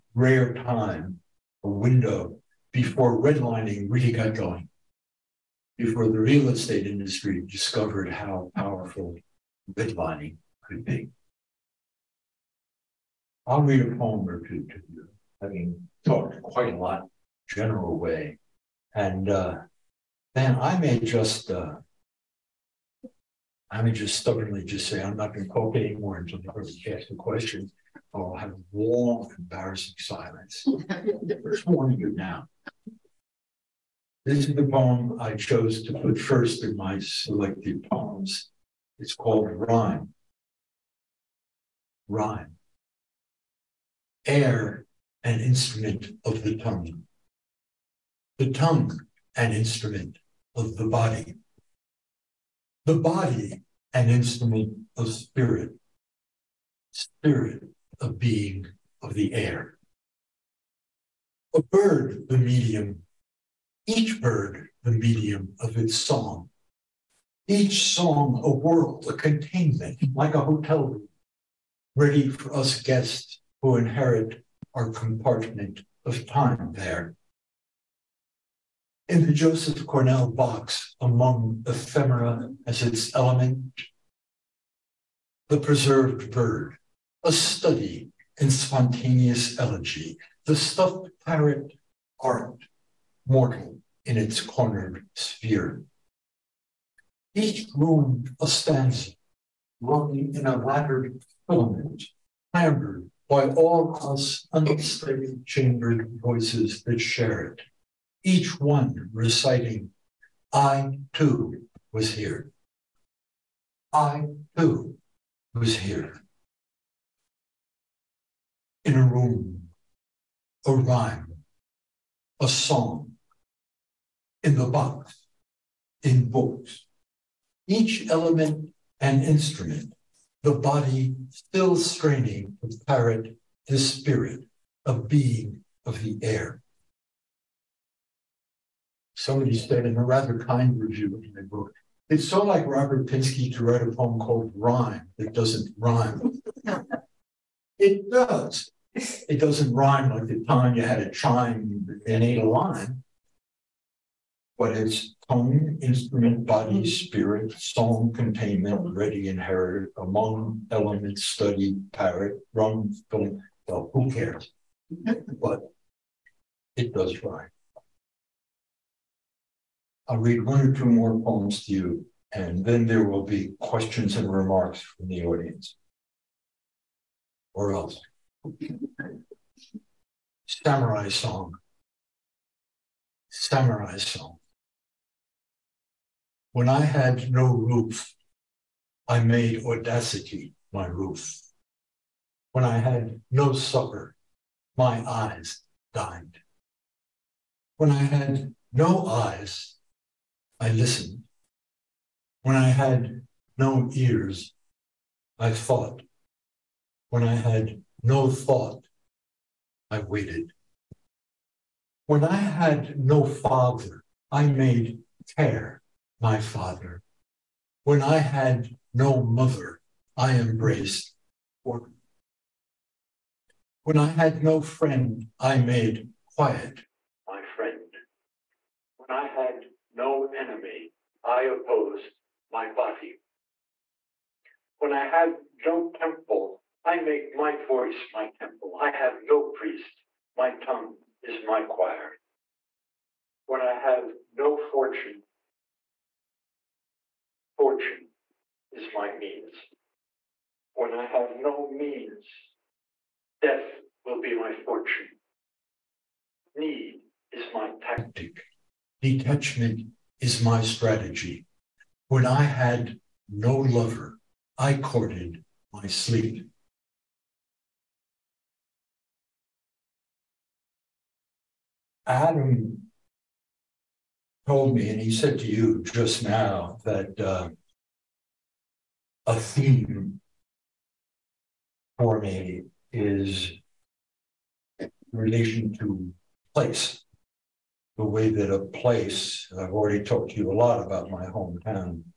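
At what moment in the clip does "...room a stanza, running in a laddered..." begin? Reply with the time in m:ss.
1:37.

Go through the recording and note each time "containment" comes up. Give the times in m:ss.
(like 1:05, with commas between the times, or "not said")
1:09, 2:38.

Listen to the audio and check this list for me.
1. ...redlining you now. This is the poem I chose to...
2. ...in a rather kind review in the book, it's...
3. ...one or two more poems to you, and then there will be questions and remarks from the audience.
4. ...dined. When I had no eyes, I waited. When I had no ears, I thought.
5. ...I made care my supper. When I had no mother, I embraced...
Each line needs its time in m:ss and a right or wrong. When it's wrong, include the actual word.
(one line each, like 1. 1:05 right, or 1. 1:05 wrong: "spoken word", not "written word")
1. 0:31 wrong: "warning", not "redlining"
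2. 2:19 right
3. 2:50 right
4. 3:15 wrong: "listened", not "waited"
5. 3:34 wrong: "father", not "supper".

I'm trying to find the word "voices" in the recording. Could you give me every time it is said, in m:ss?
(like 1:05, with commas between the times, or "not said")
1:46, 3:57.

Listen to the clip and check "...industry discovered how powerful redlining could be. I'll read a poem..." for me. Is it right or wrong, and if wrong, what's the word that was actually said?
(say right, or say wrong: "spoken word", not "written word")
right.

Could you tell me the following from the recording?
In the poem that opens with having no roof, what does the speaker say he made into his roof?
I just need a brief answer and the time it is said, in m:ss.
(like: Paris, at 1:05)
audacity, at 3:09.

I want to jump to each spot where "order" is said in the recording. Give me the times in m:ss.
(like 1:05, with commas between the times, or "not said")
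3:41.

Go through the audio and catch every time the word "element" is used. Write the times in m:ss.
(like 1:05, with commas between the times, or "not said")
1:23, 2:08, 2:40.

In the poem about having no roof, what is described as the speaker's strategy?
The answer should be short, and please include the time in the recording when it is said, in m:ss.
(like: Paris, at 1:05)
Detachment, at 4:18.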